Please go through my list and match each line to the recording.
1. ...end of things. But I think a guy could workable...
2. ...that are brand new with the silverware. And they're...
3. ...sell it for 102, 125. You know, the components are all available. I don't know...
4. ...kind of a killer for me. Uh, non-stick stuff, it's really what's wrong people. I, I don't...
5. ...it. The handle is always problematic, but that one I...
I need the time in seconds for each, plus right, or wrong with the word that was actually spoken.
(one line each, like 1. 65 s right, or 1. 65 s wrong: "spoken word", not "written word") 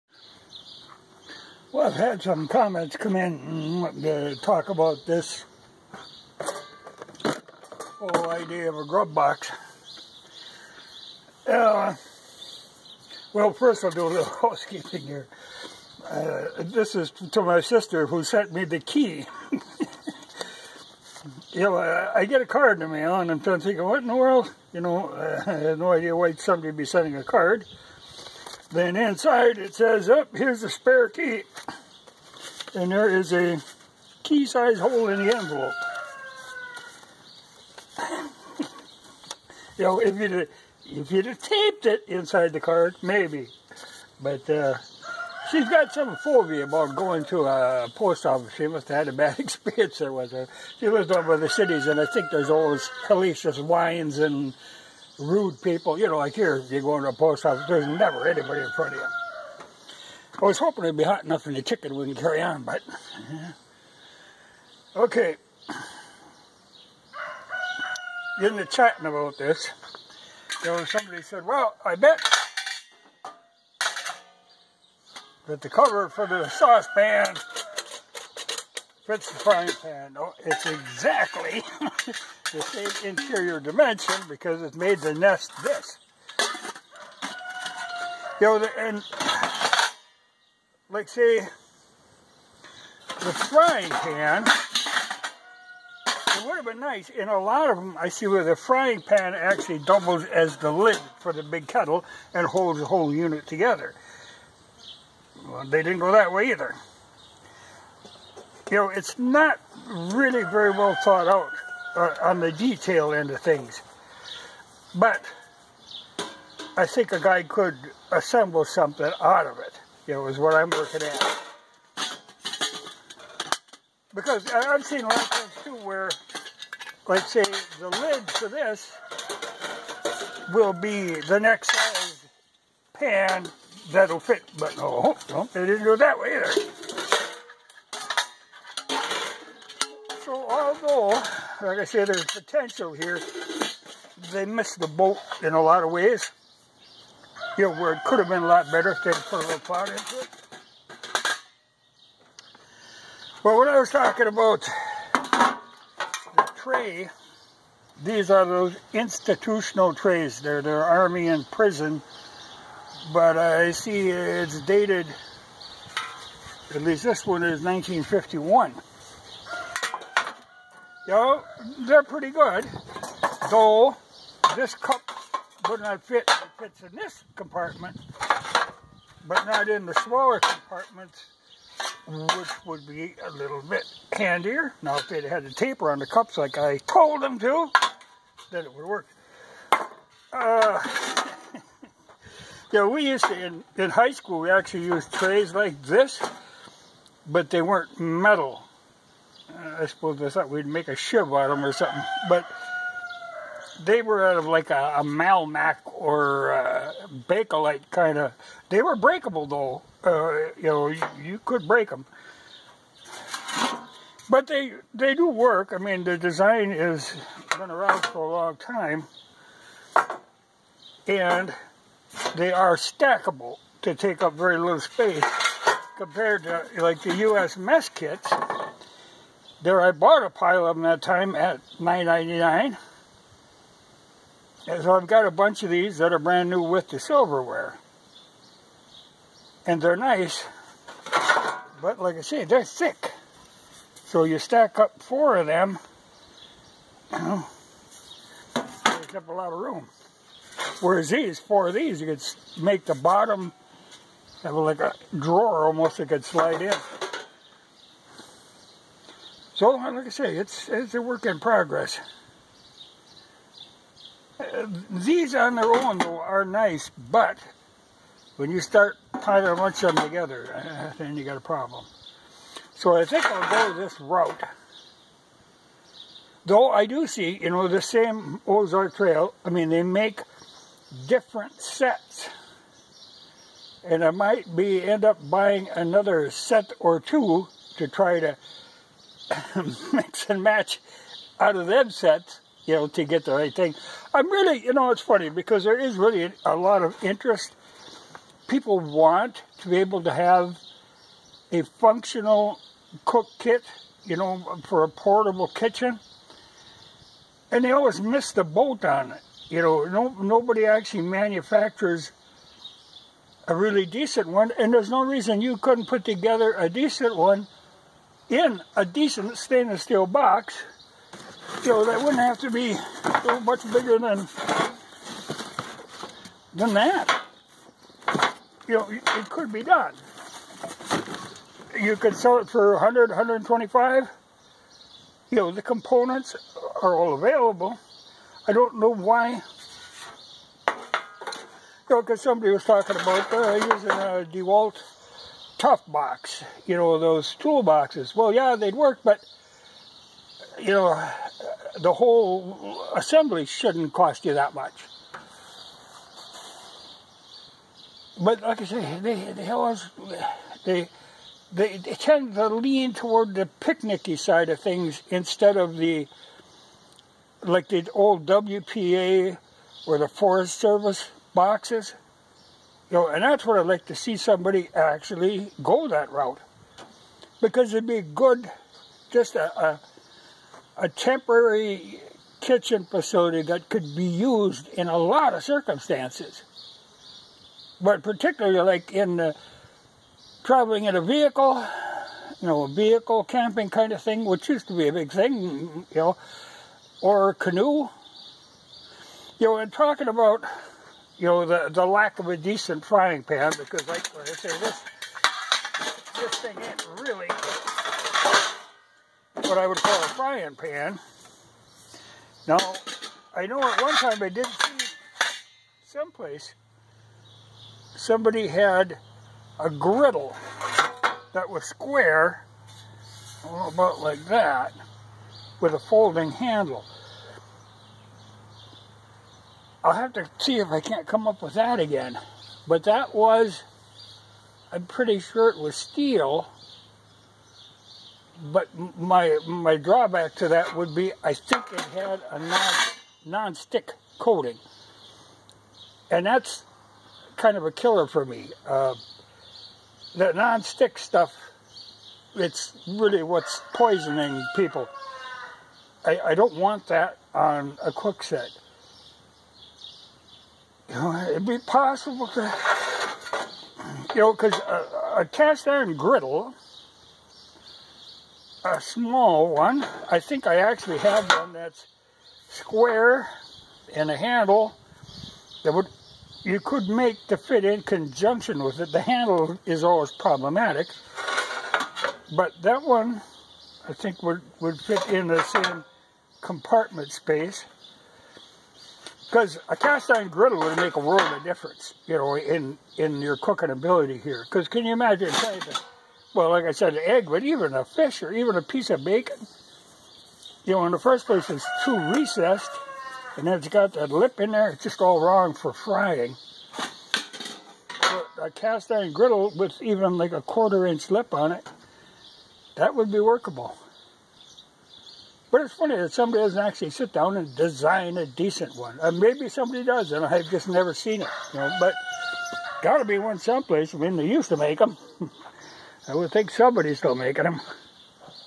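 1. 113 s wrong: "assemble", not "workable"
2. 235 s right
3. 332 s wrong: "100", not "102"
4. 447 s wrong: "poisoning", not "wrong"
5. 478 s right.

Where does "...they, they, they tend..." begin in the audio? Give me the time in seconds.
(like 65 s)
360 s.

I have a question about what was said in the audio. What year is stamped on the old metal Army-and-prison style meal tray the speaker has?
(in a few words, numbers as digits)
1951.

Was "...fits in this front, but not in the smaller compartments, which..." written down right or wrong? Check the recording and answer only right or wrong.
wrong.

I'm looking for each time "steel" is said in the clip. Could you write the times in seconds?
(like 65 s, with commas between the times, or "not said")
319 s, 435 s.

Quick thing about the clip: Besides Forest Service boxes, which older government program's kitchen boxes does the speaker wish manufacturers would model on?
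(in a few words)
WPA.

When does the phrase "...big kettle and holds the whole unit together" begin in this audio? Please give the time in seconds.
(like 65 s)
101 s.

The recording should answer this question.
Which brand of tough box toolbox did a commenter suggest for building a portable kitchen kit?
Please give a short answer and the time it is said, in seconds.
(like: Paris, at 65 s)
DeWalt, at 344 s.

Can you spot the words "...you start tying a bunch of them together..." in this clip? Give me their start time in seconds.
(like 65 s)
268 s.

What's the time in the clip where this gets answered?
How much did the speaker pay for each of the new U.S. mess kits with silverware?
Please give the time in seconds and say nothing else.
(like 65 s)
231 s.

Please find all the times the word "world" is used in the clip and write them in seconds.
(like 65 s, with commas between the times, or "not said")
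24 s, 490 s.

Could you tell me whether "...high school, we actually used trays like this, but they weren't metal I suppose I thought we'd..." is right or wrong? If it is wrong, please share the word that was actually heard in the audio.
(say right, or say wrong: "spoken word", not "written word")
right.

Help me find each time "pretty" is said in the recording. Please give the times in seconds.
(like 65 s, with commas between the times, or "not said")
172 s, 434 s.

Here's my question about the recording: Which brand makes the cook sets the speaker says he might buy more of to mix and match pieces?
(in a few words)
Ozark Trail.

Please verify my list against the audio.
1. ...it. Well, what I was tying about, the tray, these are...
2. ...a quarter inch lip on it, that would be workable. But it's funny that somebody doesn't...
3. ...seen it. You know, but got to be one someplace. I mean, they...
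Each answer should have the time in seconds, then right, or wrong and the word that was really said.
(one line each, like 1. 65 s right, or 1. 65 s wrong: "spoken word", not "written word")
1. 150 s wrong: "talking", not "tying"
2. 510 s right
3. 520 s right.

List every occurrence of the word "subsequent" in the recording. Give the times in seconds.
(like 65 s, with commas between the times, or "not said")
not said.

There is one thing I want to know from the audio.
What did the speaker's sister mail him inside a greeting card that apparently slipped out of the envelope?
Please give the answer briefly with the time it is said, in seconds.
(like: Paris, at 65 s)
spare key, at 30 s.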